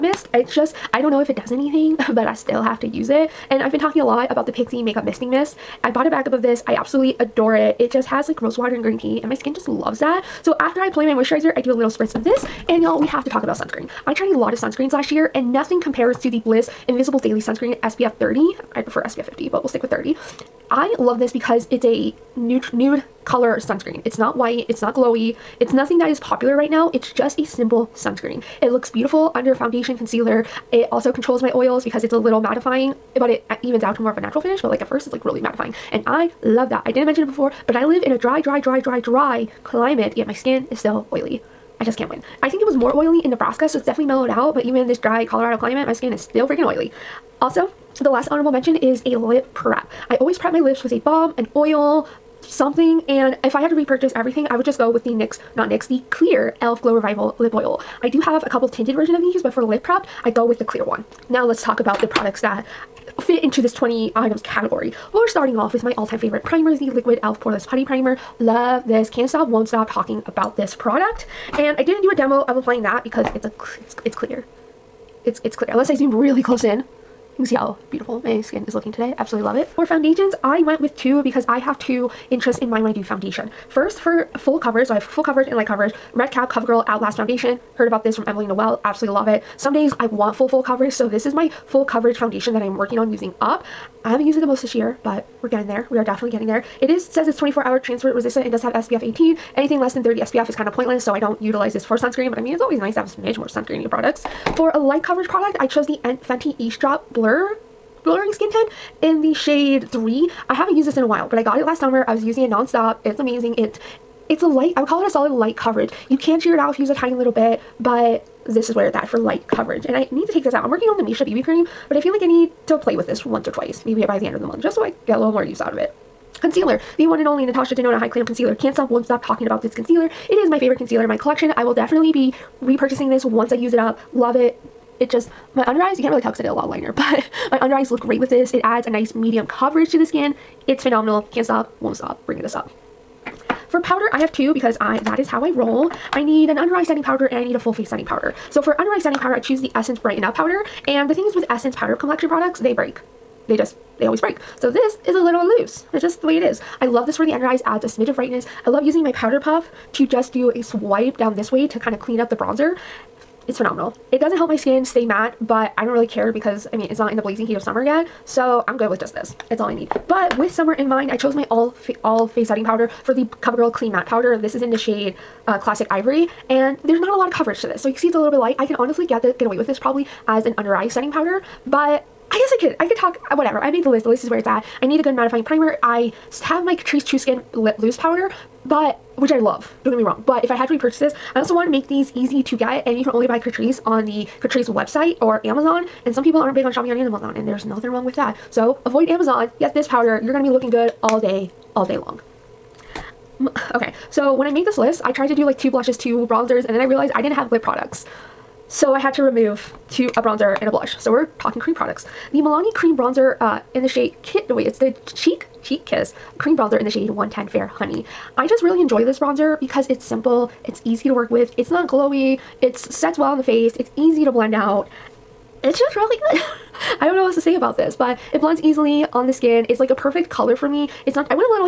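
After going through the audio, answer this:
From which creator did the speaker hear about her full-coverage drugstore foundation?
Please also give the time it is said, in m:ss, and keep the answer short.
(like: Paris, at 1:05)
Emily Noel, at 1:28.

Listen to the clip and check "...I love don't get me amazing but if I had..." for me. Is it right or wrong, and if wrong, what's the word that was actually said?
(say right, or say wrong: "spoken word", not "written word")
wrong: "wrong", not "amazing".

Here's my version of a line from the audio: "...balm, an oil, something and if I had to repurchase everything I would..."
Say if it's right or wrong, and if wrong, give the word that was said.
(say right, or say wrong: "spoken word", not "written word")
right.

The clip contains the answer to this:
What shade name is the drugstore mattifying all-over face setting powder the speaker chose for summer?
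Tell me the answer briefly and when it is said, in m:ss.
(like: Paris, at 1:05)
Classic Ivory, at 2:55.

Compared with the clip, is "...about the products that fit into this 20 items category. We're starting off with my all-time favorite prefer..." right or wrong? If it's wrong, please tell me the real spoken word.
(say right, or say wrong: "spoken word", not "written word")
wrong: "primer", not "prefer".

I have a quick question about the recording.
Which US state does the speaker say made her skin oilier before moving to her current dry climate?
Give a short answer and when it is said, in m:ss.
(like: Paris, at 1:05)
Nebraska, at 0:43.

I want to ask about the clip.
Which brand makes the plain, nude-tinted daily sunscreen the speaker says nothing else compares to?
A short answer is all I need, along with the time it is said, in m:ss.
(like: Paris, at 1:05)
Bliss, at 0:16.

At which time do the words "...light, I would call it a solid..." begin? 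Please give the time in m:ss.
1:54.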